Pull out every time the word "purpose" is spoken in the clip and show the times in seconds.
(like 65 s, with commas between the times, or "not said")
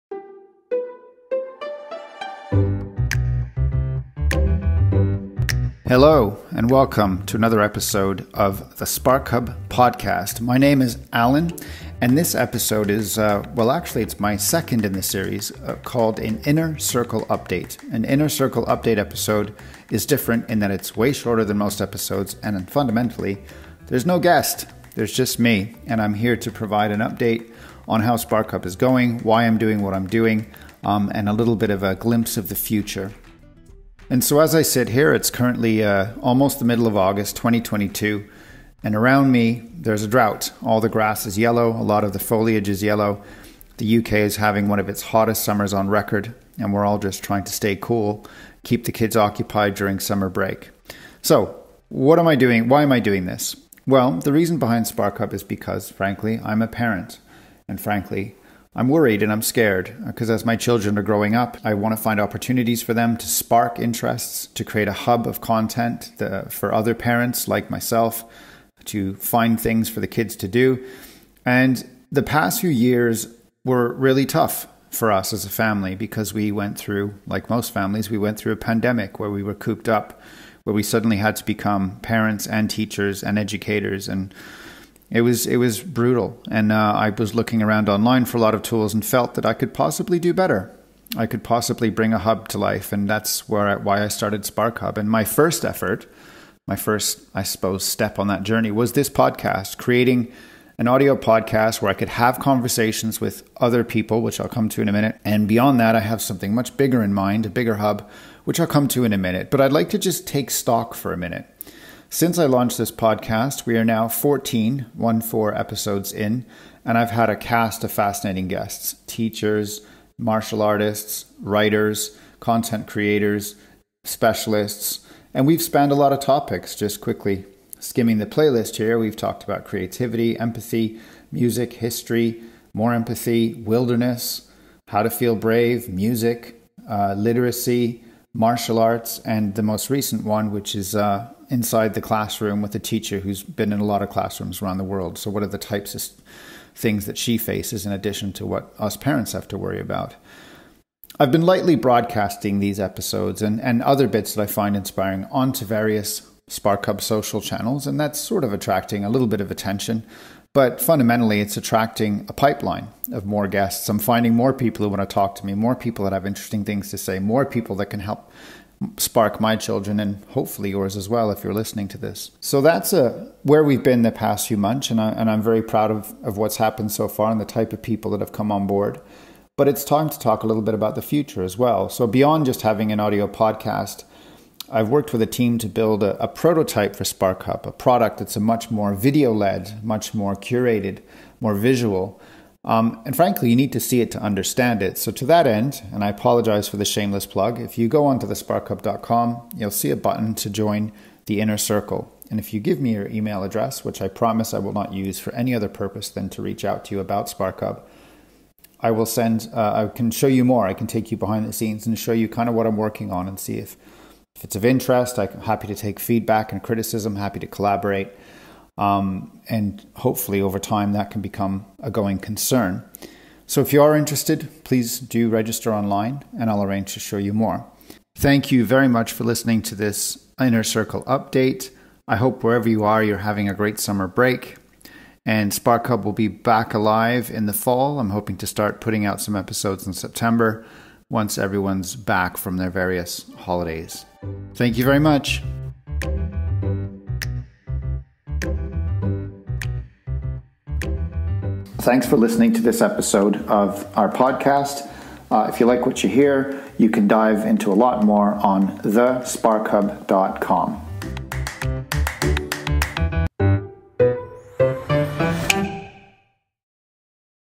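205 s.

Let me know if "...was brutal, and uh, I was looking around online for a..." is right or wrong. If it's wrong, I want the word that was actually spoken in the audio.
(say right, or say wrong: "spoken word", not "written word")
right.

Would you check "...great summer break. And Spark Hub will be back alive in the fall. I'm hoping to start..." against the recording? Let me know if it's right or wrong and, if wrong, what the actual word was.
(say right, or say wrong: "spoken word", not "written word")
right.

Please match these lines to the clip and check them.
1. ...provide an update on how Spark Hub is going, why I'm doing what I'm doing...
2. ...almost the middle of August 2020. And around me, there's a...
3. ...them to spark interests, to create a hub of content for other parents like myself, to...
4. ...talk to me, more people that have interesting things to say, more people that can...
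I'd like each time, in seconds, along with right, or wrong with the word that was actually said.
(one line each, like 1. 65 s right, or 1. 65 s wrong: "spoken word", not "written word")
1. 26 s right
2. 36 s wrong: "2022", not "2020"
3. 62 s right
4. 165 s right.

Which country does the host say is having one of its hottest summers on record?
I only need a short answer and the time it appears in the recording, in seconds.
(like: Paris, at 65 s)
UK, at 43 s.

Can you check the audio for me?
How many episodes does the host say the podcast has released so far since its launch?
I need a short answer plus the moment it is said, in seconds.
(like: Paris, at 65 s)
14, at 114 s.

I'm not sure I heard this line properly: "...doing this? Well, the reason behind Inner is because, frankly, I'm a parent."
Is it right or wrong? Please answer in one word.
wrong.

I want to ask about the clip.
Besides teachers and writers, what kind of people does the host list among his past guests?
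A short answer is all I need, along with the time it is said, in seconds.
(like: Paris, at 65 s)
Martial artists, at 120 s.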